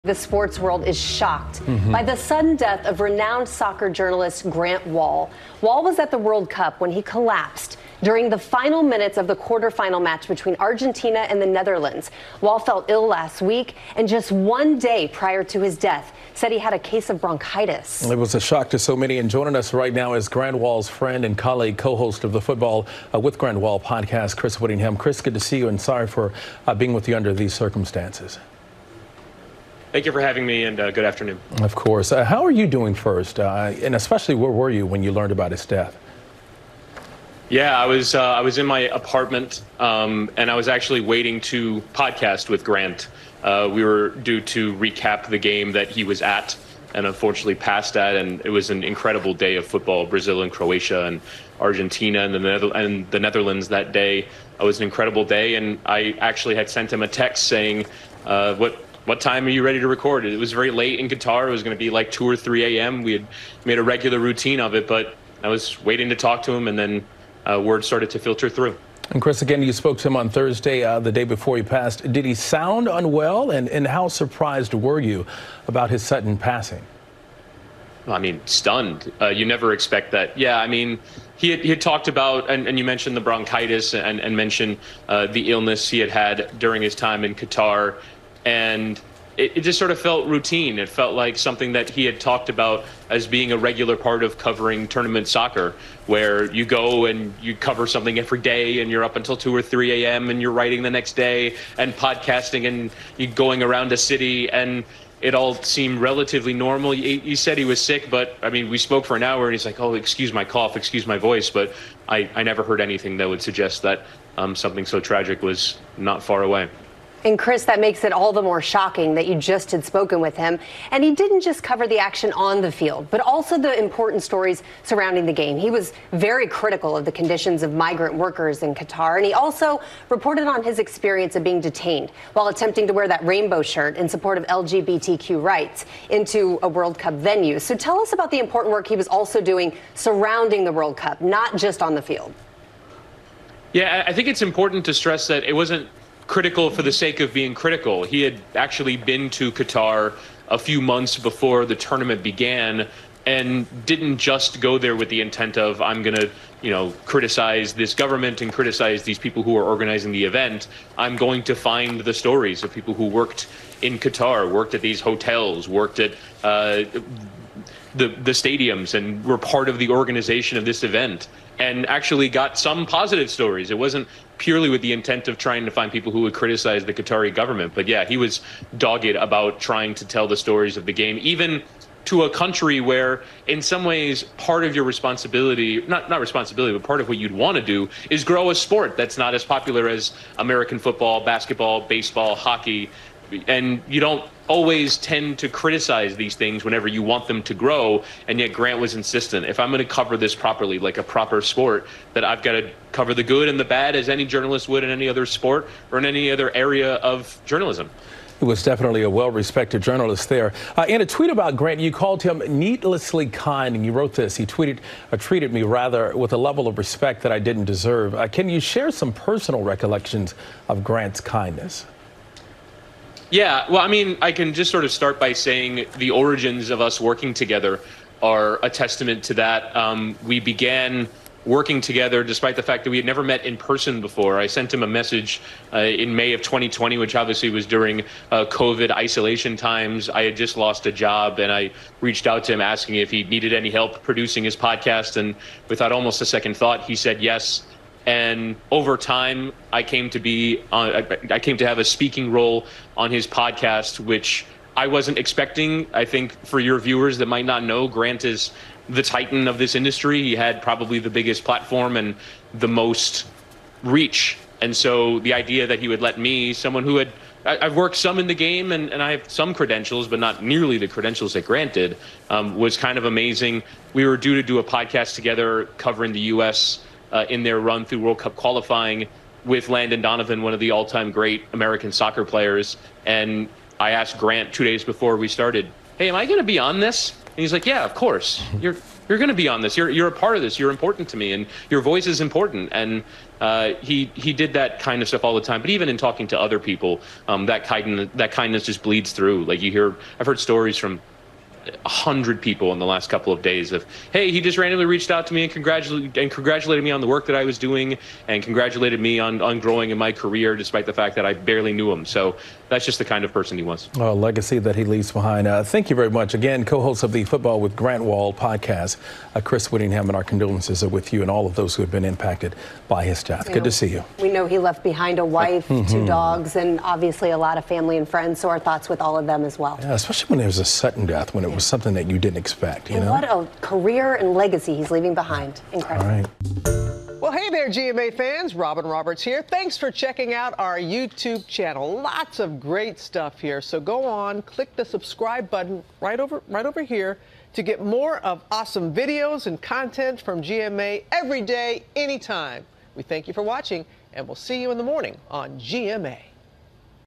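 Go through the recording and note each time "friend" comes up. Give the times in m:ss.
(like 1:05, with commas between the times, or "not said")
0:20, 5:28.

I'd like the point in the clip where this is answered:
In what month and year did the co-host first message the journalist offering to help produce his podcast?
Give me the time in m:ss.
3:56.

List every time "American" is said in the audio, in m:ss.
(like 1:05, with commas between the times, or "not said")
3:10, 4:41.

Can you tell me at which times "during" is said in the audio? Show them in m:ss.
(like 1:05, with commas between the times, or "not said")
0:08, 1:26, 3:57.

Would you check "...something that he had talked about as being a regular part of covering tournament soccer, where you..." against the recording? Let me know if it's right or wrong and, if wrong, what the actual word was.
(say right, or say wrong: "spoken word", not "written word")
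right.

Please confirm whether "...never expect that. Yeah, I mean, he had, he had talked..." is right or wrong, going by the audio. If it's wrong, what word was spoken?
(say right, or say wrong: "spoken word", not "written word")
right.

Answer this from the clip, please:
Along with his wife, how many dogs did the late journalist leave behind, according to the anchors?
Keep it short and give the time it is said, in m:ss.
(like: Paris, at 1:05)
2, at 5:25.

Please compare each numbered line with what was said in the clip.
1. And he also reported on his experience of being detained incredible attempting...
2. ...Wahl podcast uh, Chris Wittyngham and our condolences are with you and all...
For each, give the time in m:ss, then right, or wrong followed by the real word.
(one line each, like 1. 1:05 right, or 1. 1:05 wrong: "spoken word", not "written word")
1. 2:09 wrong: "while", not "incredible"
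2. 5:18 right.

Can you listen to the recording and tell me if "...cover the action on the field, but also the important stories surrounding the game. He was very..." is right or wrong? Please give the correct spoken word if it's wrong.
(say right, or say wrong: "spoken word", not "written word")
right.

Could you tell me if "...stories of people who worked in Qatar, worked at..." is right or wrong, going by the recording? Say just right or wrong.
right.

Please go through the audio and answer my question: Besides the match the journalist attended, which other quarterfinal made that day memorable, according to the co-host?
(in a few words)
Brazil and Croatia.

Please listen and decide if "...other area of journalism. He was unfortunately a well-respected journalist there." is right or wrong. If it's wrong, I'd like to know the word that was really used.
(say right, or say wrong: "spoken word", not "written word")
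wrong: "definitely", not "unfortunately".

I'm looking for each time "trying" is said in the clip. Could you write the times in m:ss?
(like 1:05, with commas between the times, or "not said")
2:55, 2:59.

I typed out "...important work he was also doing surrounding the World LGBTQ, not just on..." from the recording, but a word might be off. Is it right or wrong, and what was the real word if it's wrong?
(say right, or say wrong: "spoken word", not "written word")
wrong: "Cup", not "LGBTQ".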